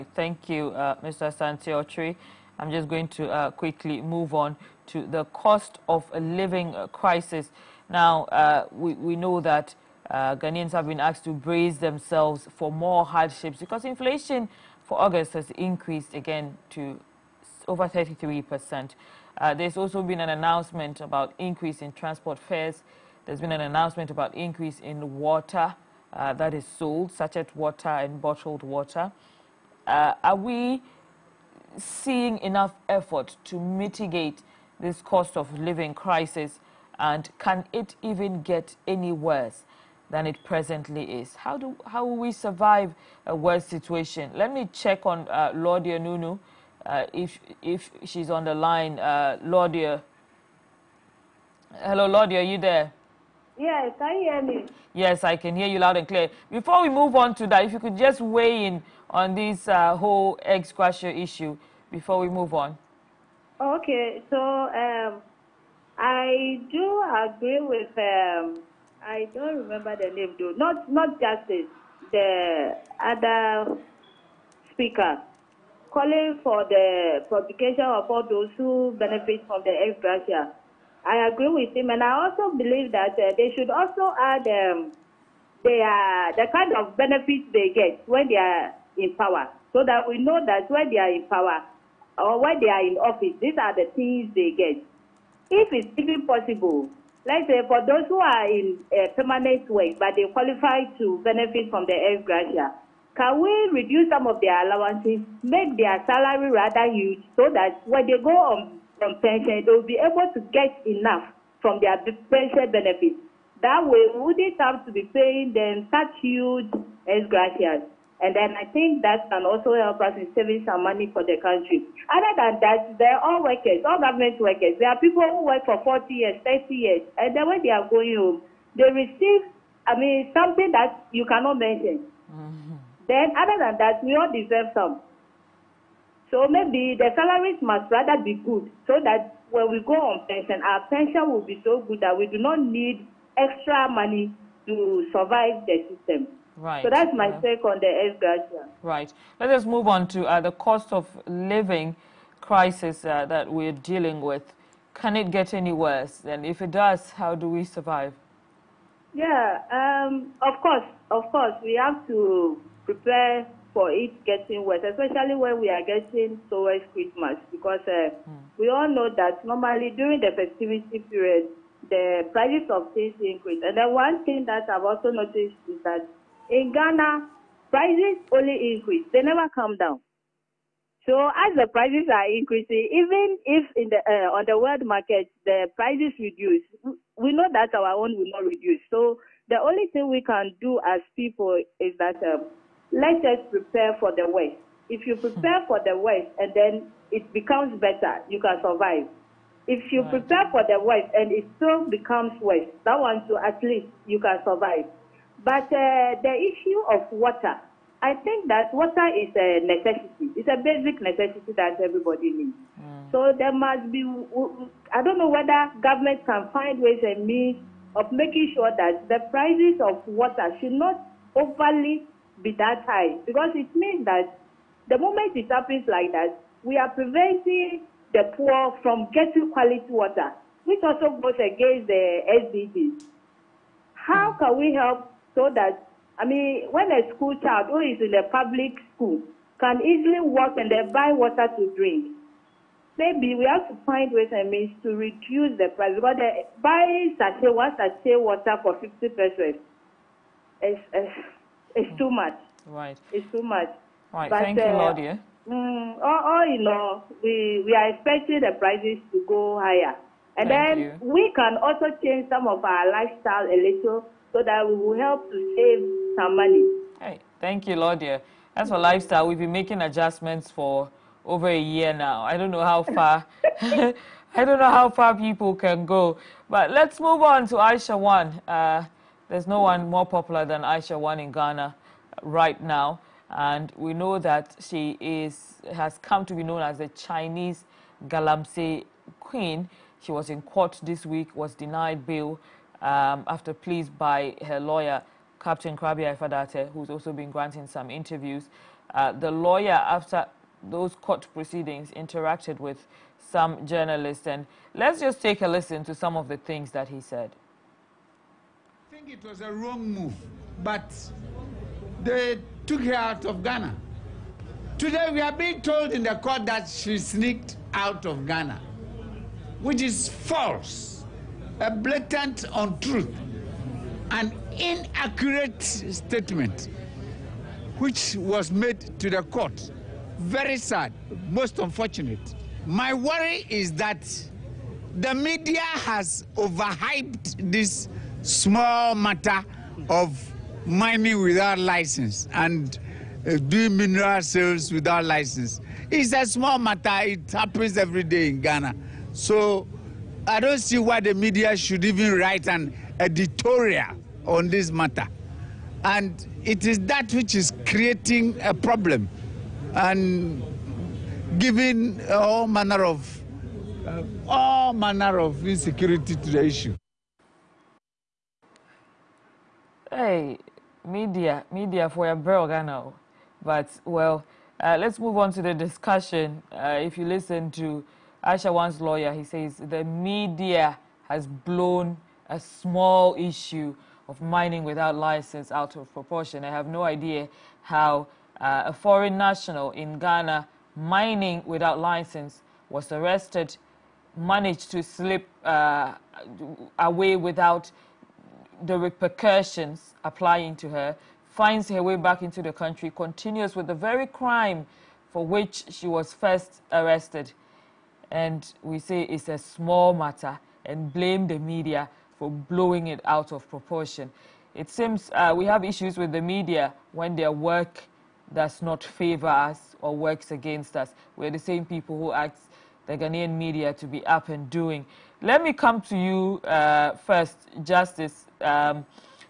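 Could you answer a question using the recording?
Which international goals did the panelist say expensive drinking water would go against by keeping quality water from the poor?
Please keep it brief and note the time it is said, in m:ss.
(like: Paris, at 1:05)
SDGs, at 3:52.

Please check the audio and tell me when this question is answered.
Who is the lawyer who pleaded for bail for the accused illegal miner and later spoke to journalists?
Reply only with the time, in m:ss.
4:55.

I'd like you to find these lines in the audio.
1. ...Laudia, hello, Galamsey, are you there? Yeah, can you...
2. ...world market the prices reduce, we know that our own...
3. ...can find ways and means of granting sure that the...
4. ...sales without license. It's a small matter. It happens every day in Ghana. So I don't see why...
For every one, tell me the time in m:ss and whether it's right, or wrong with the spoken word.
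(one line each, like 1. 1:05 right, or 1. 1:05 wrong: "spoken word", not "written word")
1. 0:49 wrong: "Laudia", not "Galamsey"
2. 3:04 right
3. 3:36 wrong: "making", not "granting"
4. 5:44 right.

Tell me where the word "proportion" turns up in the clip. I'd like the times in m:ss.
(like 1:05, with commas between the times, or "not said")
6:25, 6:53.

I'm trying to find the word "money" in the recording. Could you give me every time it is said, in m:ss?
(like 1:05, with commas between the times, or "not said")
2:00, 2:23, 4:26.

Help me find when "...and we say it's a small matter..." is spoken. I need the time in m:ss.
6:48.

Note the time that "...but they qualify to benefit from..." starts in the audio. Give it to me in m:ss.
1:39.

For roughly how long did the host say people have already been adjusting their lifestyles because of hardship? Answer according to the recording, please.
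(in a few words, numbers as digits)
over a year.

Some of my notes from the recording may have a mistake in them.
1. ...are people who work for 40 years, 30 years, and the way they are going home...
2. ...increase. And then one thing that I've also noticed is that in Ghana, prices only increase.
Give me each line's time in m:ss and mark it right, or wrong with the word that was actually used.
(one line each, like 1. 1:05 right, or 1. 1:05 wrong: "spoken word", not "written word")
1. 2:04 right
2. 2:53 right.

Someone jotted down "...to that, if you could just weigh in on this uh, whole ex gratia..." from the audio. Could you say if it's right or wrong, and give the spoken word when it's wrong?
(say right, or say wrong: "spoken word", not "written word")
right.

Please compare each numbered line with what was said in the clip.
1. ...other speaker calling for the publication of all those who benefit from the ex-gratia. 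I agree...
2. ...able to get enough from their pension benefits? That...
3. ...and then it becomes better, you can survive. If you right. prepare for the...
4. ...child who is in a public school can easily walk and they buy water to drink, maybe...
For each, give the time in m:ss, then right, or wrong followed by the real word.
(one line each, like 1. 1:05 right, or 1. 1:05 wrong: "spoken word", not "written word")
1. 1:13 right
2. 1:50 right
3. 3:16 right
4. 3:57 right.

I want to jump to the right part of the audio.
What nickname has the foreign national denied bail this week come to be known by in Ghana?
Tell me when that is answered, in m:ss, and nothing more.
4:46.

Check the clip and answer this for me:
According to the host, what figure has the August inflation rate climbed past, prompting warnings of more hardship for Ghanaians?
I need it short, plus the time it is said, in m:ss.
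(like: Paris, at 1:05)
33%, at 0:17.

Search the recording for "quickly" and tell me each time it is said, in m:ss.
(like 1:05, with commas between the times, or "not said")
0:03.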